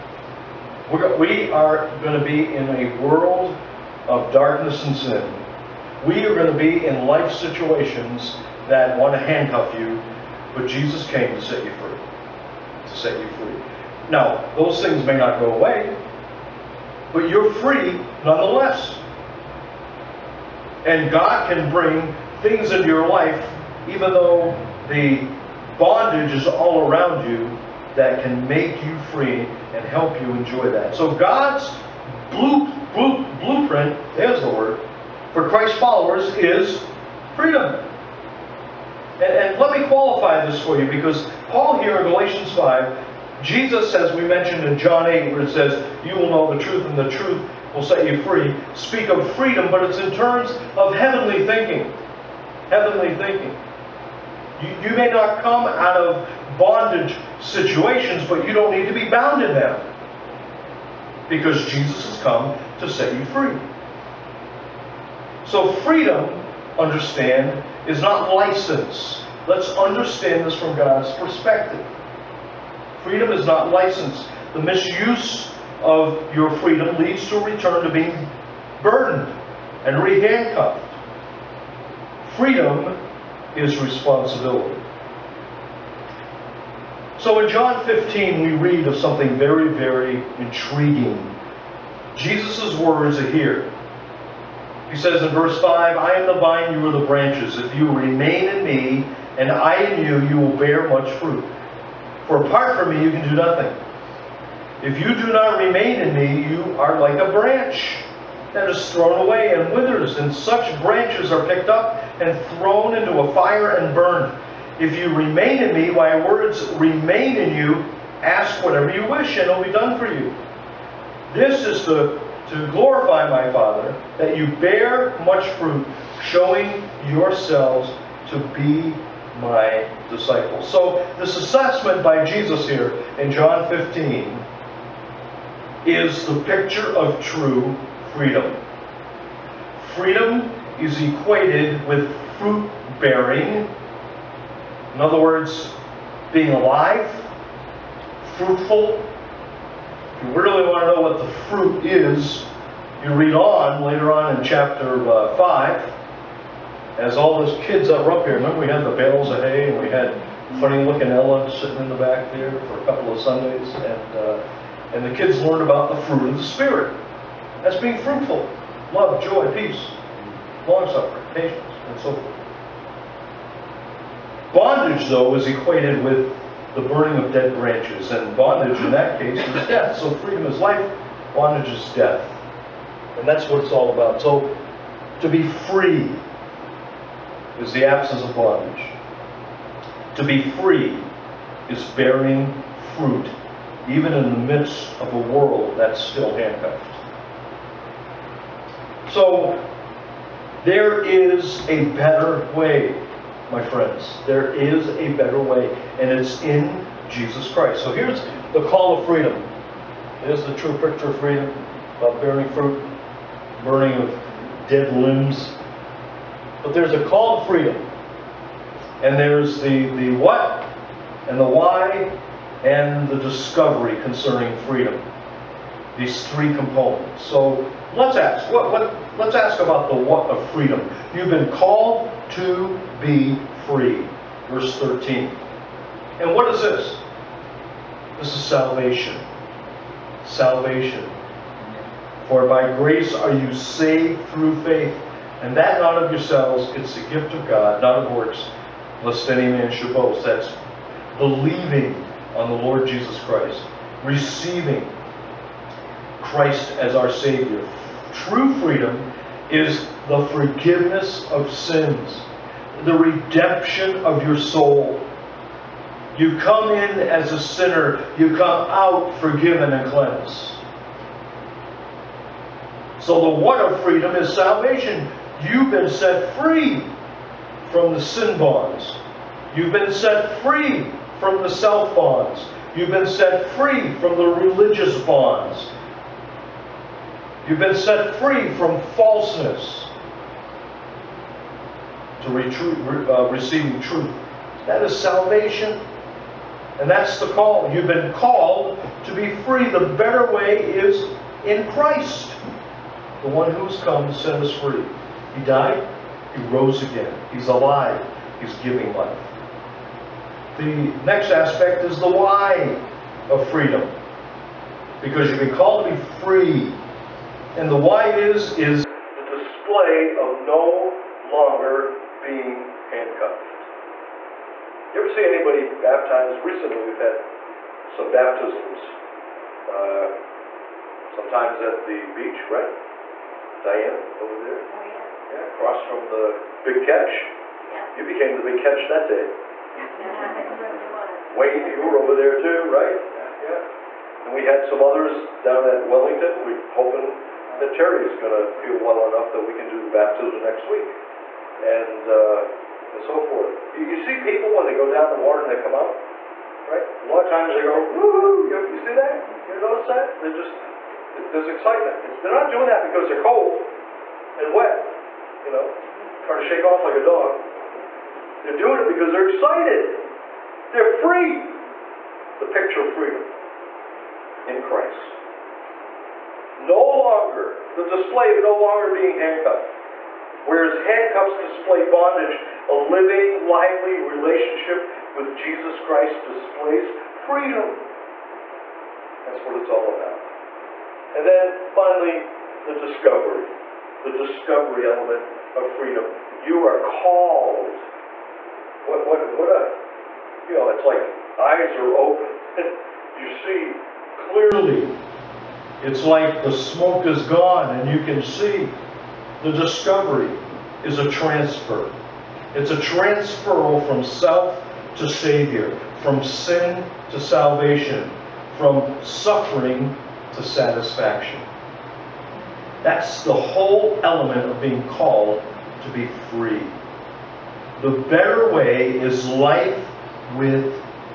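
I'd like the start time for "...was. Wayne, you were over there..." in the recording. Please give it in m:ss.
5:40.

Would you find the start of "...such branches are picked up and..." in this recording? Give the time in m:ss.
1:50.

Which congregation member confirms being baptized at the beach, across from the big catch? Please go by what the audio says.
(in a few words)
Diane.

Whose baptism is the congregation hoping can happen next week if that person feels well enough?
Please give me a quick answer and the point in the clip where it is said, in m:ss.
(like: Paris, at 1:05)
Terry, at 5:47.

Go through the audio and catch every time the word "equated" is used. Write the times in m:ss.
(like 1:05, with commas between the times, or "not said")
2:21, 2:55.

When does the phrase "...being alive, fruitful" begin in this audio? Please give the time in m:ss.
2:26.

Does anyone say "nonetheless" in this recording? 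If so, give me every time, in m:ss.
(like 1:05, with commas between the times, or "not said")
0:18.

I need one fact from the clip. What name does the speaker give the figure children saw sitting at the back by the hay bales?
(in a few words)
Ella.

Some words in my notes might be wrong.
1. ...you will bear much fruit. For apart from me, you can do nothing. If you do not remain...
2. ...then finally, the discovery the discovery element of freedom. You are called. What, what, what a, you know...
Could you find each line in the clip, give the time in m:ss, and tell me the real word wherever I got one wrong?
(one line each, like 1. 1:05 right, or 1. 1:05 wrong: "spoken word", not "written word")
1. 1:40 right
2. 6:31 right.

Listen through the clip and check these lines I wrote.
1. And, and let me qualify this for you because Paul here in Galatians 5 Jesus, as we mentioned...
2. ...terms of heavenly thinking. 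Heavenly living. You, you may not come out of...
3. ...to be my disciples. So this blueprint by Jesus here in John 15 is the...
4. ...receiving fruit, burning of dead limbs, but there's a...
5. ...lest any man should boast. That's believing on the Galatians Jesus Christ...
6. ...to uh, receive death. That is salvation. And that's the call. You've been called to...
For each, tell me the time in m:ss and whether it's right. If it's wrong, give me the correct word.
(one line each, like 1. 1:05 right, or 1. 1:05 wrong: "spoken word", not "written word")
1. 0:39 right
2. 0:50 wrong: "thinking", not "living"
3. 2:08 wrong: "assessment", not "blueprint"
4. 3:32 wrong: "bearing", not "receiving"
5. 4:09 wrong: "Lord", not "Galatians"
6. 4:52 wrong: "truth", not "death".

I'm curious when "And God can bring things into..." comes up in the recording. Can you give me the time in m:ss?
0:20.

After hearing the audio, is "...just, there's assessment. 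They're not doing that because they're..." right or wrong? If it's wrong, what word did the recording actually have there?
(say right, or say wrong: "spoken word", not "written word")
wrong: "excitement", not "assessment".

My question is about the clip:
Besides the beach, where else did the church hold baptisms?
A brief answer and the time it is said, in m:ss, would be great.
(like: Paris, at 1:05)
Wellington, at 5:45.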